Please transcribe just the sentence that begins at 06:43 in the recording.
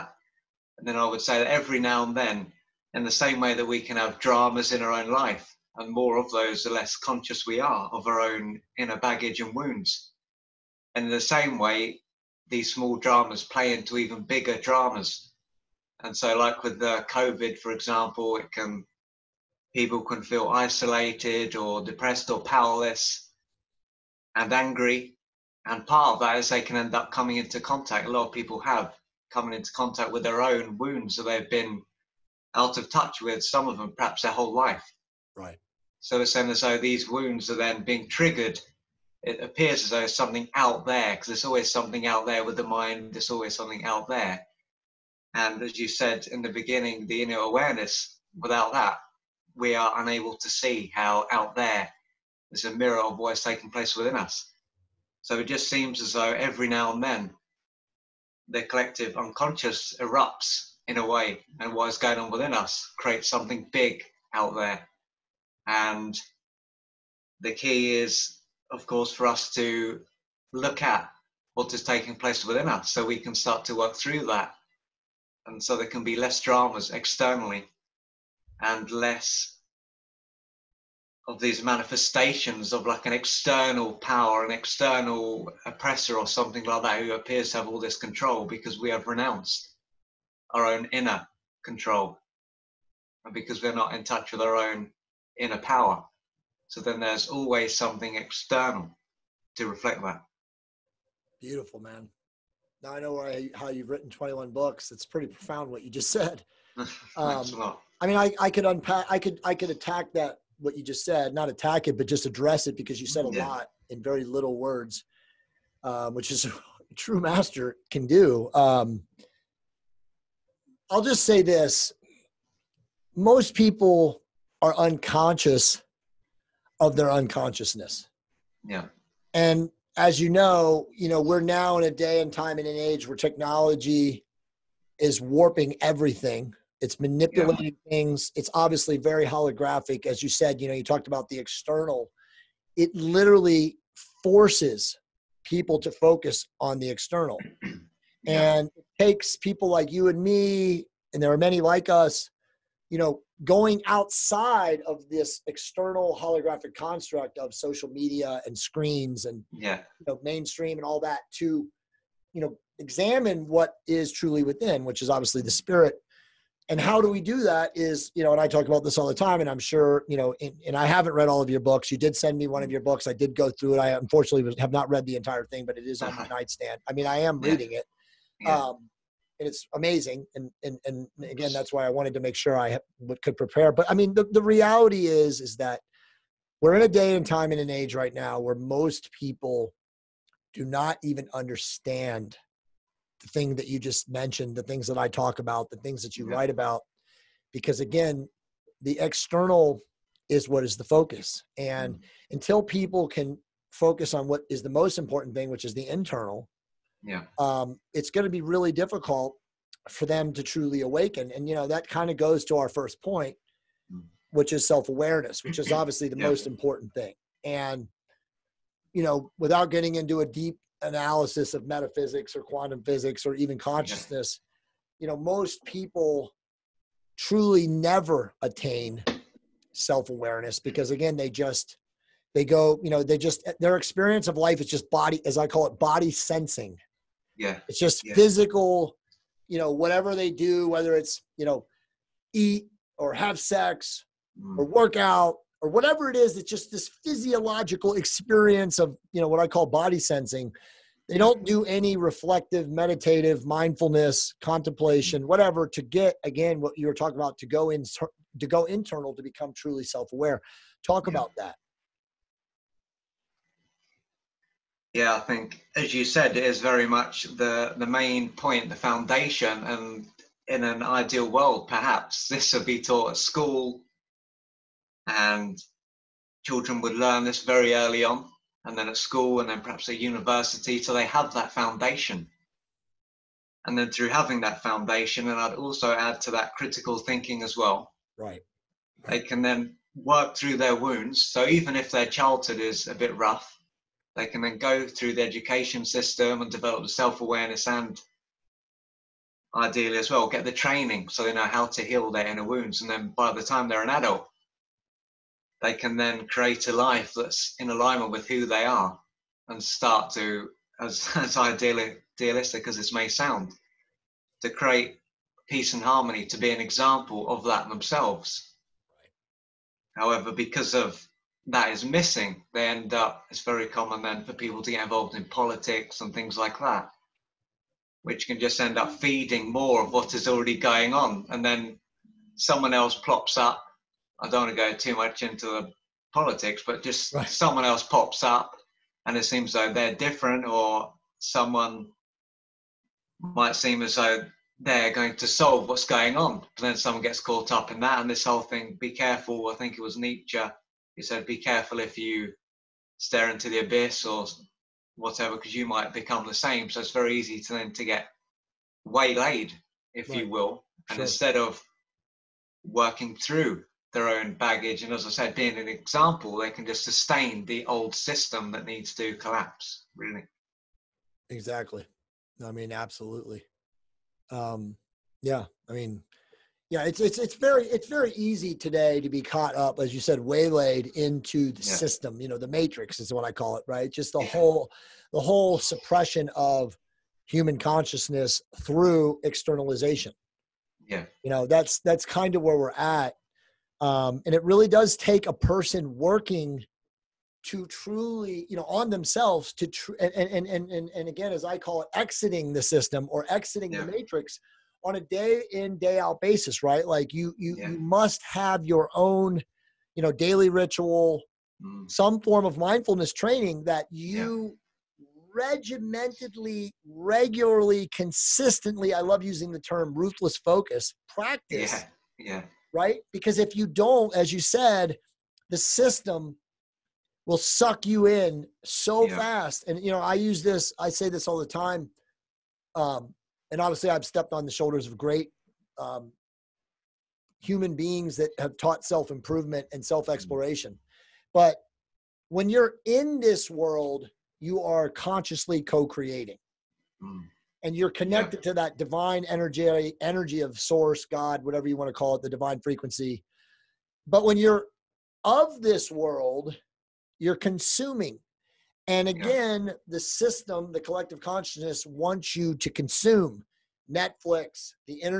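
the matrix on a day in day out basis right like you you, yeah.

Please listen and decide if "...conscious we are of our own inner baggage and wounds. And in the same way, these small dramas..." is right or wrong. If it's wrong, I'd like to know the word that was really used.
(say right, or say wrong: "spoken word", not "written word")
right.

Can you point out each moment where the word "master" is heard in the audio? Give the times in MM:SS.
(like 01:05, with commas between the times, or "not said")
01:57.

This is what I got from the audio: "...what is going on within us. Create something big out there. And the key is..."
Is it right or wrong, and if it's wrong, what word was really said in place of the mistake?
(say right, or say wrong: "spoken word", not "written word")
right.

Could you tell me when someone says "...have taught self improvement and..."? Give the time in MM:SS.
07:18.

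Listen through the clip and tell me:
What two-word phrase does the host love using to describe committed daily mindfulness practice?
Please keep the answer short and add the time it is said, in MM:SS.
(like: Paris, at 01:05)
ruthless focus, at 06:59.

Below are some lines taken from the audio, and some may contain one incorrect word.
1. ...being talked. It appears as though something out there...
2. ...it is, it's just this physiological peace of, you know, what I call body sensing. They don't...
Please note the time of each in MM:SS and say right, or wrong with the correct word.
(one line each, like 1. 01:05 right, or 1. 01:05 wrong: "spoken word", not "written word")
1. 00:37 wrong: "triggered", not "talked"
2. 04:06 wrong: "experience", not "peace".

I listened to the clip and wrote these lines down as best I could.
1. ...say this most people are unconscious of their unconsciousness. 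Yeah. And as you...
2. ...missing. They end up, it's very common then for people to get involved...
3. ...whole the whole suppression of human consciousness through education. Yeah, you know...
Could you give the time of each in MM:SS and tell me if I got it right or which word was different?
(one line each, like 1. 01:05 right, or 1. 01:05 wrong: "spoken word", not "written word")
1. 02:01 right
2. 05:21 right
3. 06:24 wrong: "externalization", not "education".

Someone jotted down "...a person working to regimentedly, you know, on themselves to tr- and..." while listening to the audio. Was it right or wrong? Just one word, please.
wrong.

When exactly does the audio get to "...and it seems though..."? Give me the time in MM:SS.
05:39.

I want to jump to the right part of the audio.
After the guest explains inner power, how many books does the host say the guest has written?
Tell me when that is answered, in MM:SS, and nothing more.
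01:44.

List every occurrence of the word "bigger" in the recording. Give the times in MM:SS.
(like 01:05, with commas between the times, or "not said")
00:14.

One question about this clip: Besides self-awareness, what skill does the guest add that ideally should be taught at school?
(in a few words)
critical thinking.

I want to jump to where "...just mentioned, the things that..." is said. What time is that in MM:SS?
03:13.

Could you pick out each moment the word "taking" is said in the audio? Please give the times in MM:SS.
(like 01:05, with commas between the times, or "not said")
00:53, 01:11.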